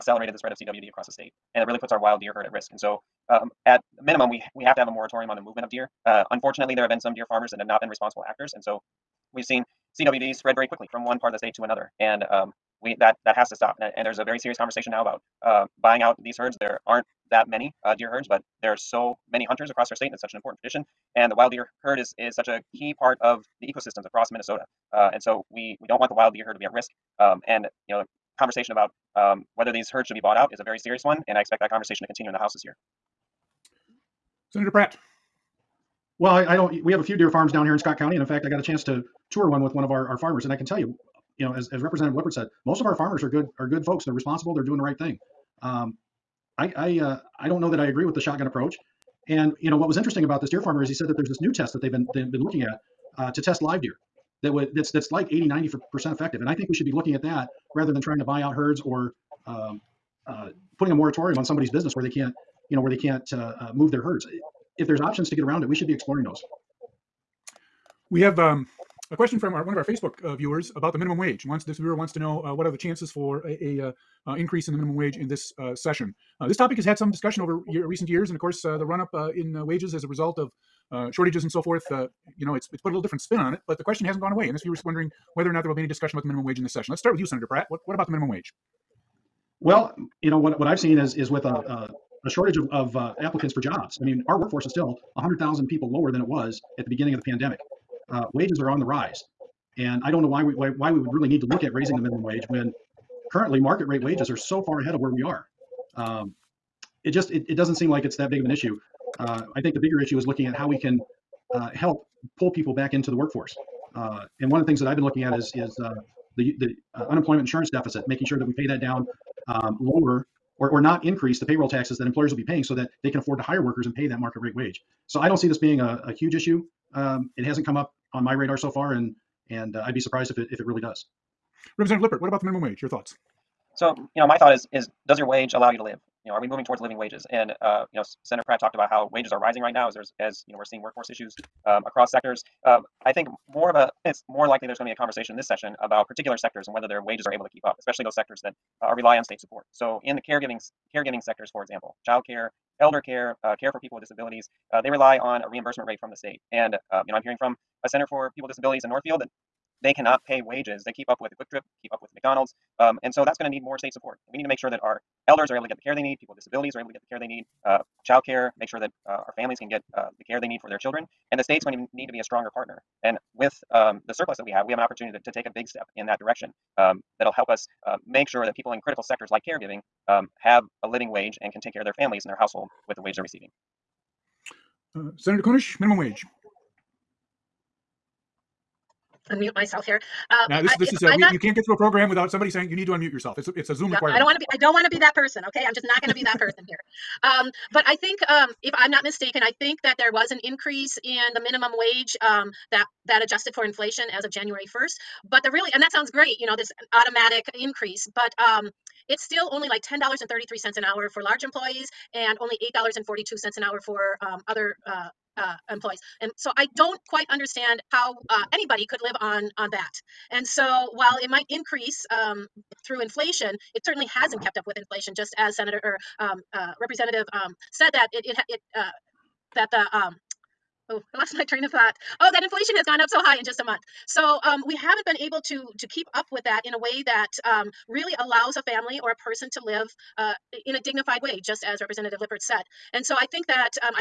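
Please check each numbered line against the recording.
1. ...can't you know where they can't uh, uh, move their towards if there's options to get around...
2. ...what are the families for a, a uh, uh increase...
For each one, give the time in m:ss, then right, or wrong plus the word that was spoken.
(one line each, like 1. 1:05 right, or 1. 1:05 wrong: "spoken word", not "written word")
1. 1:02 wrong: "herds", not "towards"
2. 1:12 wrong: "chances", not "families".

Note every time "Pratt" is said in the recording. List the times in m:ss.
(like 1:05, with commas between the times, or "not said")
0:34, 1:27, 2:18.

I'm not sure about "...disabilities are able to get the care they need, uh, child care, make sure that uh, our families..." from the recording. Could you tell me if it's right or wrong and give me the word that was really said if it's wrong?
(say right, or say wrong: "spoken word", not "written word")
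right.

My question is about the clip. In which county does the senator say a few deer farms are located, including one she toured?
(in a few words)
Scott County.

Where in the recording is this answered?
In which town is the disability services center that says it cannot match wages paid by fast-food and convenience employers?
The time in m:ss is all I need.
2:38.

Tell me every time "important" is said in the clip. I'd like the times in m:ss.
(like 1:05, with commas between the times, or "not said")
0:20.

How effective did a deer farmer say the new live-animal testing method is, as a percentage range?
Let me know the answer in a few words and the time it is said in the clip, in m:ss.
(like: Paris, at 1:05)
80-90 percent, at 0:55.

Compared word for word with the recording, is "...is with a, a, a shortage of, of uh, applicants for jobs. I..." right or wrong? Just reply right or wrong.
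right.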